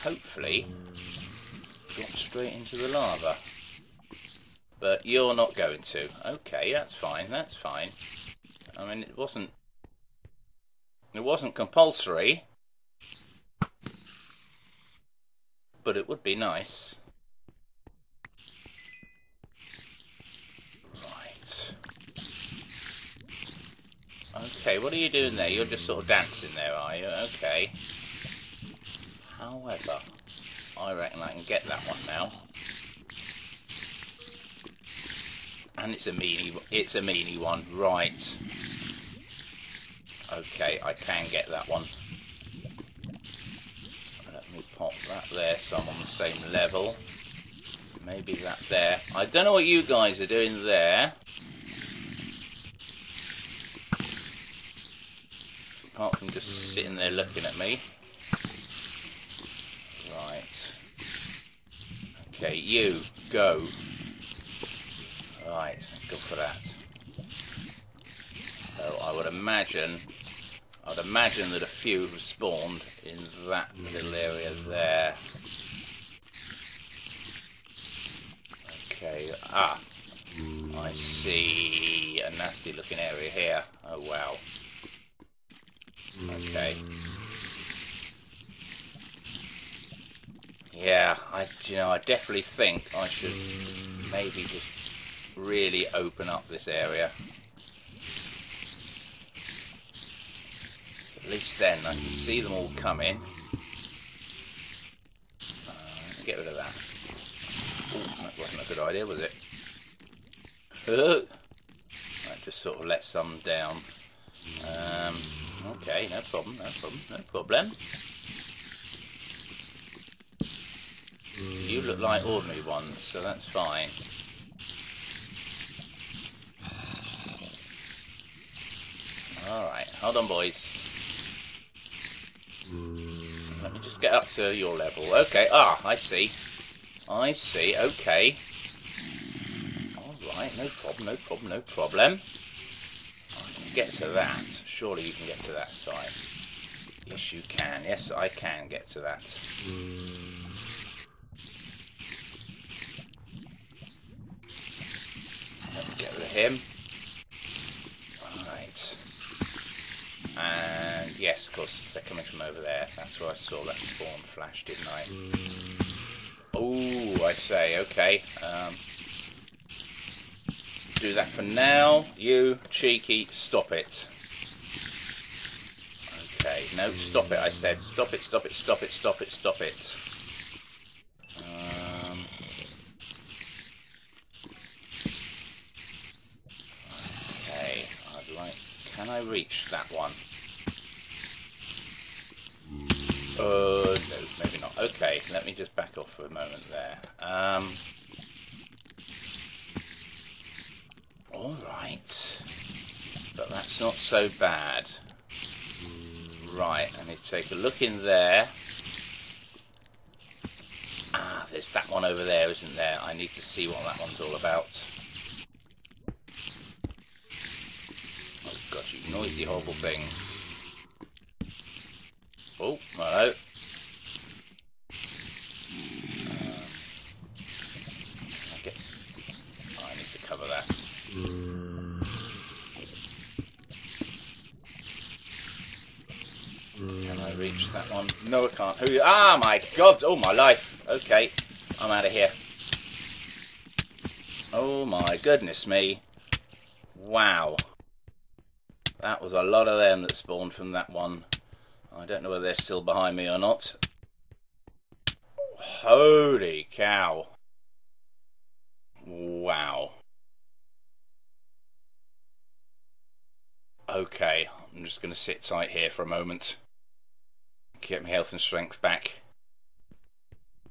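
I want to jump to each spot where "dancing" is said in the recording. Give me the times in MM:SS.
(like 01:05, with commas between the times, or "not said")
00:26.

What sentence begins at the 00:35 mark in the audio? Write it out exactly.
And it's a meanie, it's a meanie one, right.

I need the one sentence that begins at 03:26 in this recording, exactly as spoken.
Right, I need to take a look in there.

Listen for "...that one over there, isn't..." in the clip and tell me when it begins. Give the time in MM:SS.
03:31.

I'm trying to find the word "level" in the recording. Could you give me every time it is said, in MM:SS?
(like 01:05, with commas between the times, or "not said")
00:46, 02:14.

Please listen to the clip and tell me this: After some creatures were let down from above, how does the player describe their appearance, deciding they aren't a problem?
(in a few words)
ordinary.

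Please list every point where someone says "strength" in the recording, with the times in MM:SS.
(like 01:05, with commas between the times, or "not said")
04:28.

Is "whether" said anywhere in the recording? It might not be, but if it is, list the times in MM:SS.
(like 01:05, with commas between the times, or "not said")
04:12.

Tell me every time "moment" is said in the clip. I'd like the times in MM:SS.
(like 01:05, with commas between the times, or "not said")
03:16, 04:26.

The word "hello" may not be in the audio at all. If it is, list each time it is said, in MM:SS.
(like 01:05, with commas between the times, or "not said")
03:42.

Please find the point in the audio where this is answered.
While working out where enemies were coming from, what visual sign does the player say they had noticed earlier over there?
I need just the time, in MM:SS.
02:43.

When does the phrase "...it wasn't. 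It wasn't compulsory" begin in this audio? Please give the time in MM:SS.
00:09.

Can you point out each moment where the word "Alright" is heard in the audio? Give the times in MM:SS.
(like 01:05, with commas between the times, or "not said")
02:09, 02:19.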